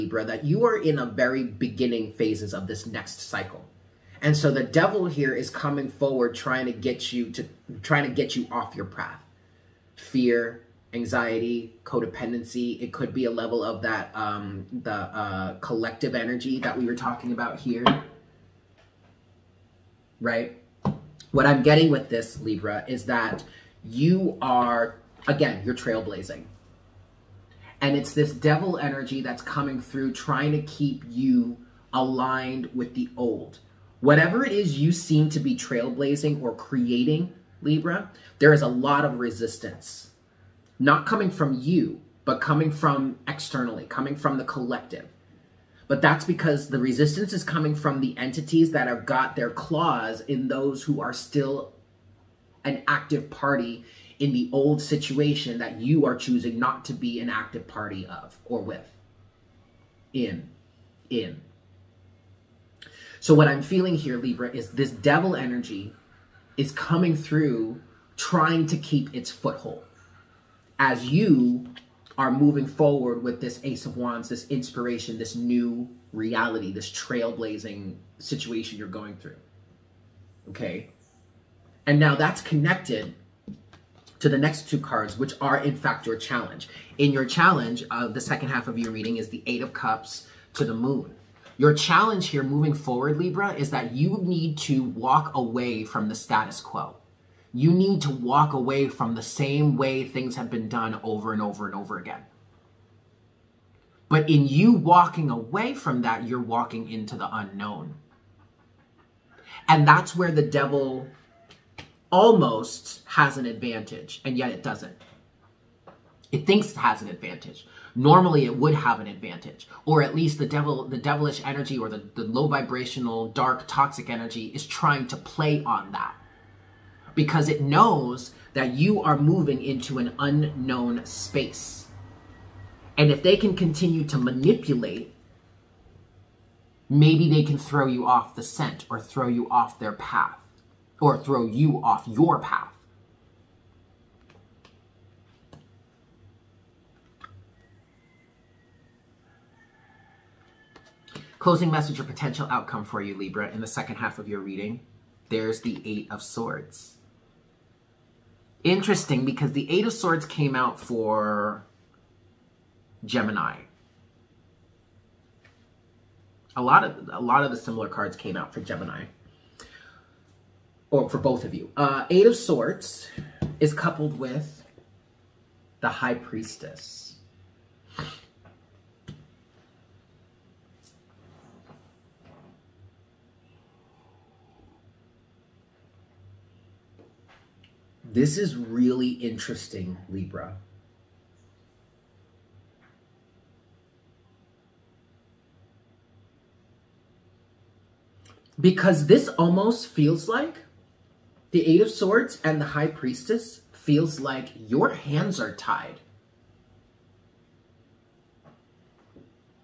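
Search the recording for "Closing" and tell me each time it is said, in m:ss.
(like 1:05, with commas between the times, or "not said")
2:31.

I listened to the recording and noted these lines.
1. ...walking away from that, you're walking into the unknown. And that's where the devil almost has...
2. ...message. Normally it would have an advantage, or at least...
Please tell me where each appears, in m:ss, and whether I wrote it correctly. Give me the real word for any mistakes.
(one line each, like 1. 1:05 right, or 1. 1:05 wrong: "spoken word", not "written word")
1. 1:44 right
2. 1:57 wrong: "advantage", not "message".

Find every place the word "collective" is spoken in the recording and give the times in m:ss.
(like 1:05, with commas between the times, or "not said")
0:15, 0:44.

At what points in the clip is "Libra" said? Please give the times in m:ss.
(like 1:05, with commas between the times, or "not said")
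0:22, 0:37, 1:04, 1:33, 2:33, 3:10.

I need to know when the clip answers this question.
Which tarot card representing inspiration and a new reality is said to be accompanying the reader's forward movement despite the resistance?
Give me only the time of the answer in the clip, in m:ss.
1:13.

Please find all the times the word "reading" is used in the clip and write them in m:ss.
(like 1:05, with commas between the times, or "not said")
1:28, 2:34.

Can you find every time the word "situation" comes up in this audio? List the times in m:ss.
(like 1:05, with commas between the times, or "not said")
0:54, 1:18.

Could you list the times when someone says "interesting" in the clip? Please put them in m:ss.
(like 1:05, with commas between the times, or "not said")
2:38, 3:09.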